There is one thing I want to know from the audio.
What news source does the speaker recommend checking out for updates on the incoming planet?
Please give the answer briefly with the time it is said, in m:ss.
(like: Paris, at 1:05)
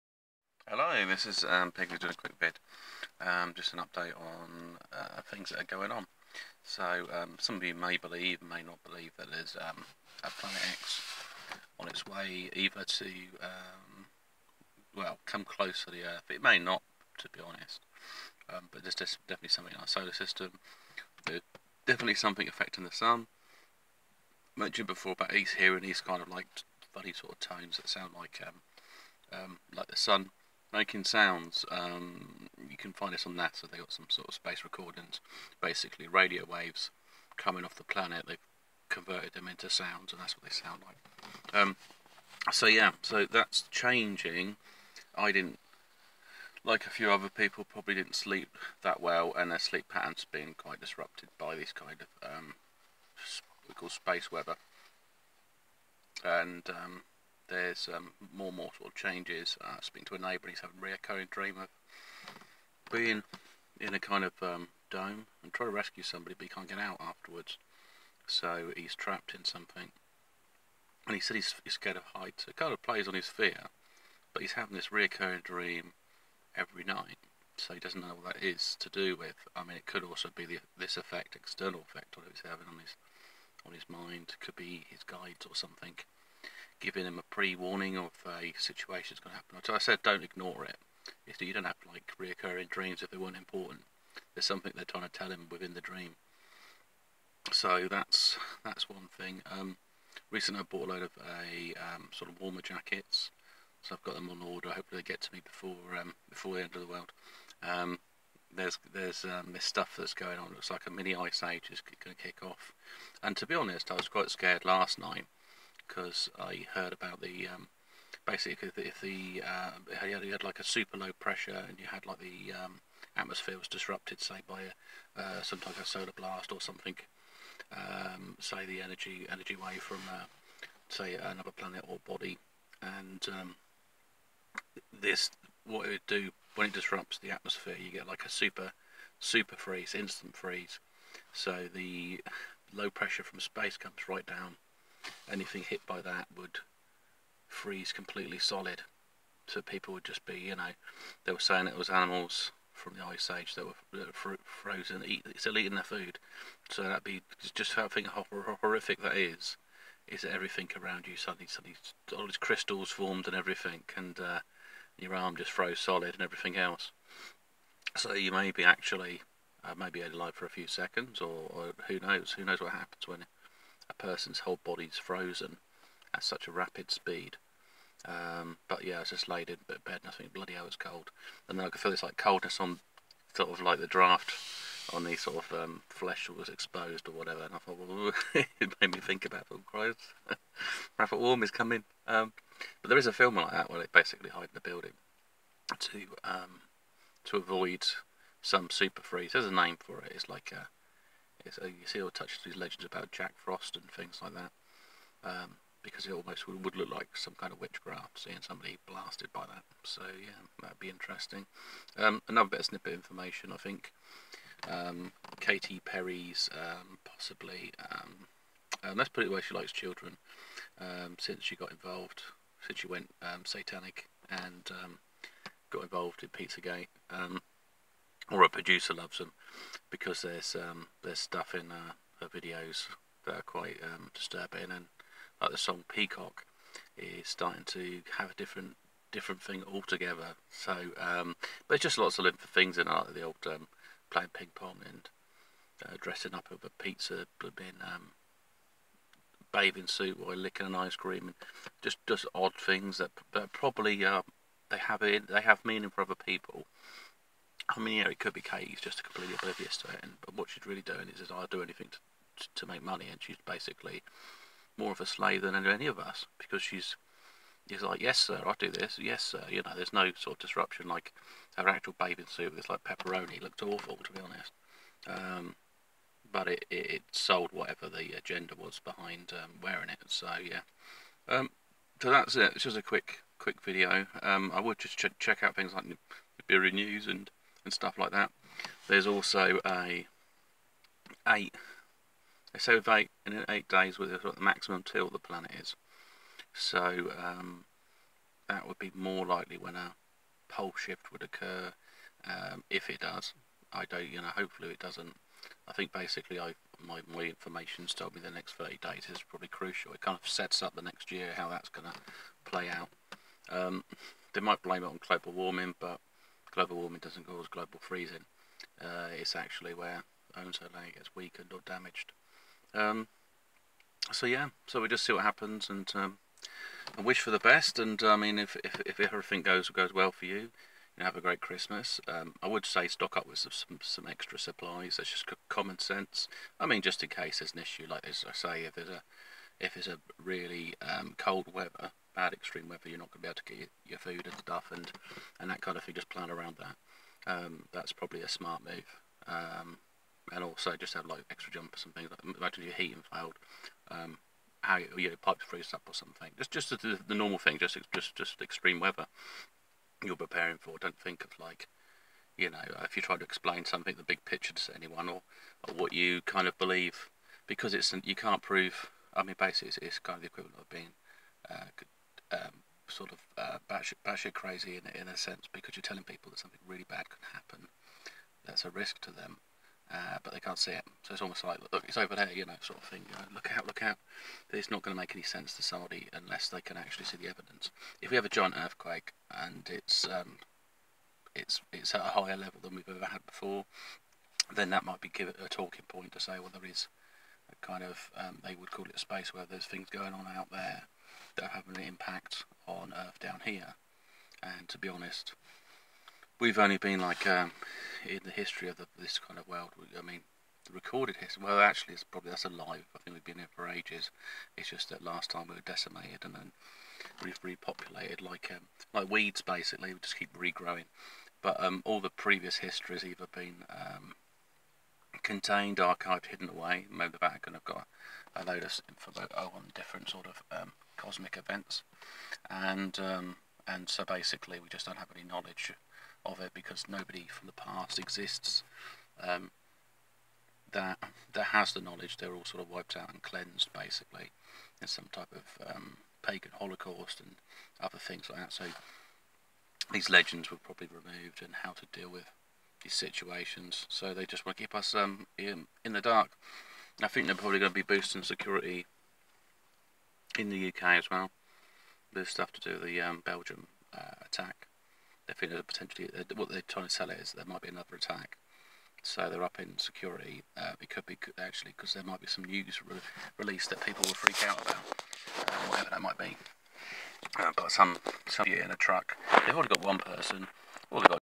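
Nibiru News, at 4:46.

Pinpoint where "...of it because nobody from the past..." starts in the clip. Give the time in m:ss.
7:16.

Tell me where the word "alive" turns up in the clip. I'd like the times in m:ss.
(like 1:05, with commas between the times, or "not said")
2:50, 6:52.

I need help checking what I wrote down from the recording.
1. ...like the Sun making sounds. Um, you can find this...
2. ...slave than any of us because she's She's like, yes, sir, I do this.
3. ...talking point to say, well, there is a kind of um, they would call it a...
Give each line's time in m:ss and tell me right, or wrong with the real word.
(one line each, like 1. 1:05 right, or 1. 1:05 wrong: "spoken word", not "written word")
1. 0:29 right
2. 4:25 right
3. 6:35 right.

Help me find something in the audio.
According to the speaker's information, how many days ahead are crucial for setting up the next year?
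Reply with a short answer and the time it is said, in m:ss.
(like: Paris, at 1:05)
30, at 5:08.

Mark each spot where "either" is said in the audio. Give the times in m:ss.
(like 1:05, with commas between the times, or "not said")
0:12, 7:03.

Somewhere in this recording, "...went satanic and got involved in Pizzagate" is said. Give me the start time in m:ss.
3:42.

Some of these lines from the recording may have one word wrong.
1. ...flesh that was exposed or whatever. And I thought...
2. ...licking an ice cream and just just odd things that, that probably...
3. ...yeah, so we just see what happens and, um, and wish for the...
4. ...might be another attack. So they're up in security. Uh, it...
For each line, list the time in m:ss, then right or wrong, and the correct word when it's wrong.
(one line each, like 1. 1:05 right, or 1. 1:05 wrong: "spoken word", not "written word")
1. 3:05 right
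2. 4:10 right
3. 5:24 right
4. 7:47 right.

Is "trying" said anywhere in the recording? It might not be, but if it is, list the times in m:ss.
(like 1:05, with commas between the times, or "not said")
1:05, 1:34, 7:46.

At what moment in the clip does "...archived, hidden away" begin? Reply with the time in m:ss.
7:05.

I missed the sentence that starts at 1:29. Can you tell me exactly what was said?
So I said, don't ignore it.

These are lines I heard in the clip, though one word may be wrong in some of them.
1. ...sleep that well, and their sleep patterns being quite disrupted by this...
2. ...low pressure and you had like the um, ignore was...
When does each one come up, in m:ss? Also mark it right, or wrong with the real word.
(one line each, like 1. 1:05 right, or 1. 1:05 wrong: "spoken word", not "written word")
1. 0:48 right
2. 2:00 wrong: "atmosphere", not "ignore".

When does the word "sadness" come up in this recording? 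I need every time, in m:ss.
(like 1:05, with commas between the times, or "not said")
not said.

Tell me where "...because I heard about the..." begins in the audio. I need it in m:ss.
1:55.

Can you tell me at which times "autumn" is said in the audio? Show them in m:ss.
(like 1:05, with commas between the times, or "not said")
not said.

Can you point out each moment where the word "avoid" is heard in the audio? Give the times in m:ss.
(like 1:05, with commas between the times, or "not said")
3:17.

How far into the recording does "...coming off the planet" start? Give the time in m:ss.
0:37.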